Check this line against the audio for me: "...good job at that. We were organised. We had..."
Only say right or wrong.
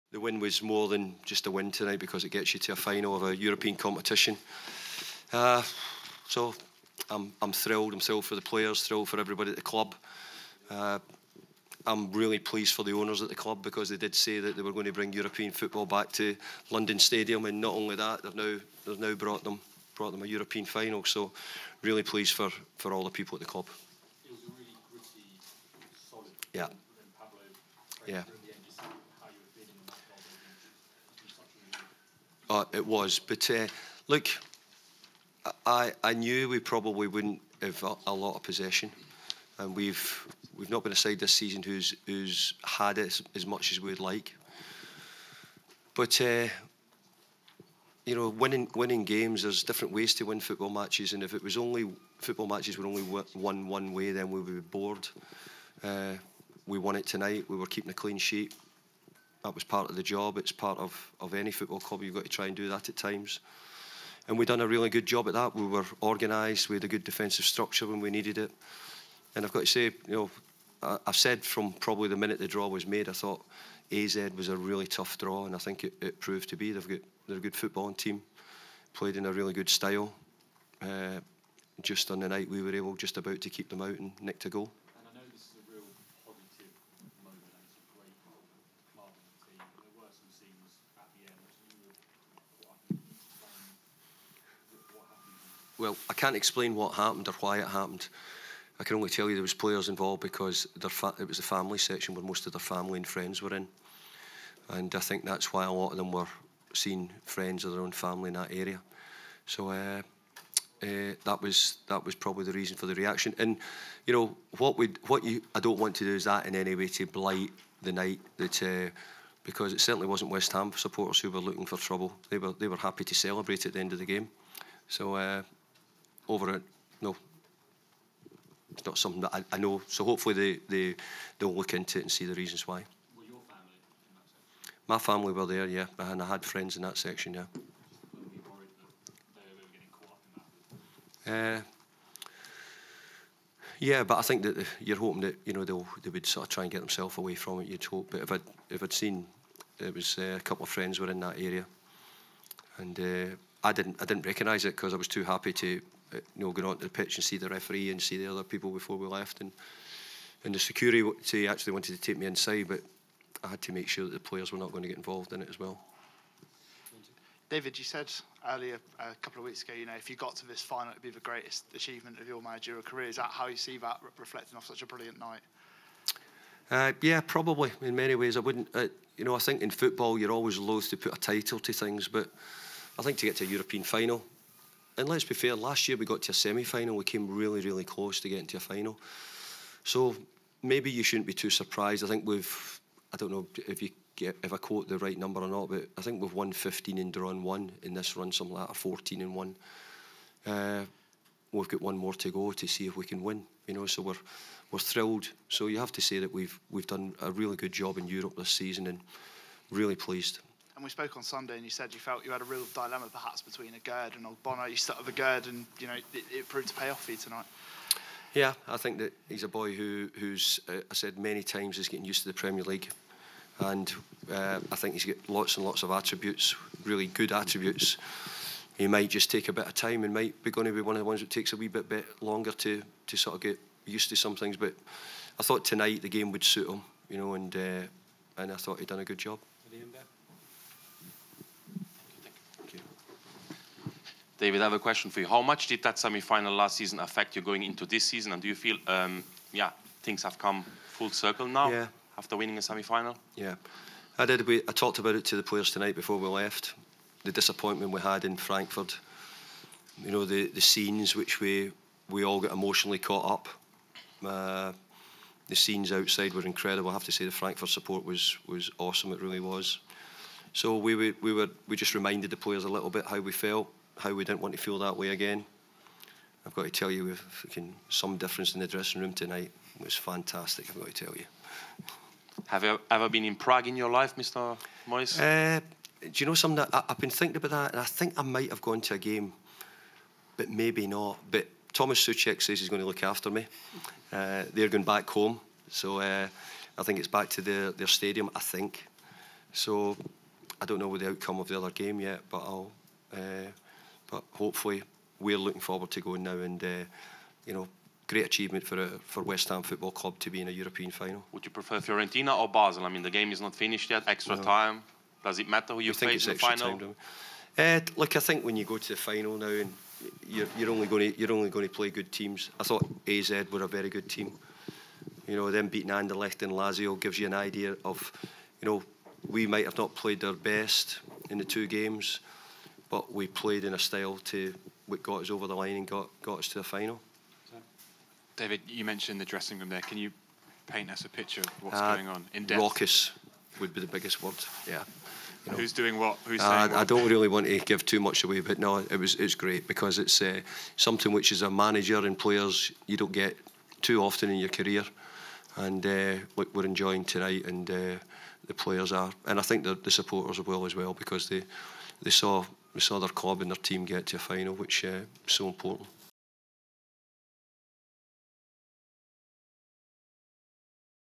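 right.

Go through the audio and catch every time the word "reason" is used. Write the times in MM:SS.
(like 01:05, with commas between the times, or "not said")
01:52, 02:12.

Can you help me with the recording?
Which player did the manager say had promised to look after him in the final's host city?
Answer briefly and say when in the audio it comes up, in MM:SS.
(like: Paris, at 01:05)
Thomas Soucek, at 04:51.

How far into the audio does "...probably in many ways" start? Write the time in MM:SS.
02:57.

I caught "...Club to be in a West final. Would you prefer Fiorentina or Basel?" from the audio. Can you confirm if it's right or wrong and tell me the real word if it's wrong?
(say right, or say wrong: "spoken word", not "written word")
wrong: "European", not "West".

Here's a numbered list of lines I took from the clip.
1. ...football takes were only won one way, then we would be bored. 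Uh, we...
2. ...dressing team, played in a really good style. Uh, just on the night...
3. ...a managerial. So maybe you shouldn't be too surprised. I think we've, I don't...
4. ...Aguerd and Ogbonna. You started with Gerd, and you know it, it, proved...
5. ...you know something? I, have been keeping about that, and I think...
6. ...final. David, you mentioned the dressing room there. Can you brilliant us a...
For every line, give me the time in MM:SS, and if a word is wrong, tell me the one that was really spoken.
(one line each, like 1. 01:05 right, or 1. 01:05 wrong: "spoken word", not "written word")
1. 00:52 wrong: "matches", not "takes"
2. 01:17 wrong: "footballing", not "dressing"
3. 03:08 wrong: "final", not "managerial"
4. 03:33 right
5. 04:46 wrong: "thinking", not "keeping"
6. 05:36 wrong: "paint", not "brilliant".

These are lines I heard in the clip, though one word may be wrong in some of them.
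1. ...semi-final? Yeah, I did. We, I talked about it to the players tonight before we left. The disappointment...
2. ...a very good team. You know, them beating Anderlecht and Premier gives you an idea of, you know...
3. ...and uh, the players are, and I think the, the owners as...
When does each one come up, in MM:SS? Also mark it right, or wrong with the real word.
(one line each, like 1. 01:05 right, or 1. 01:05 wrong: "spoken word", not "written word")
1. 04:12 right
2. 05:23 wrong: "Lazio", not "Premier"
3. 05:57 wrong: "supporters", not "owners".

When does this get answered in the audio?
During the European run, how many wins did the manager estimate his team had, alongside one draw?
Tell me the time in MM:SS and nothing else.
03:16.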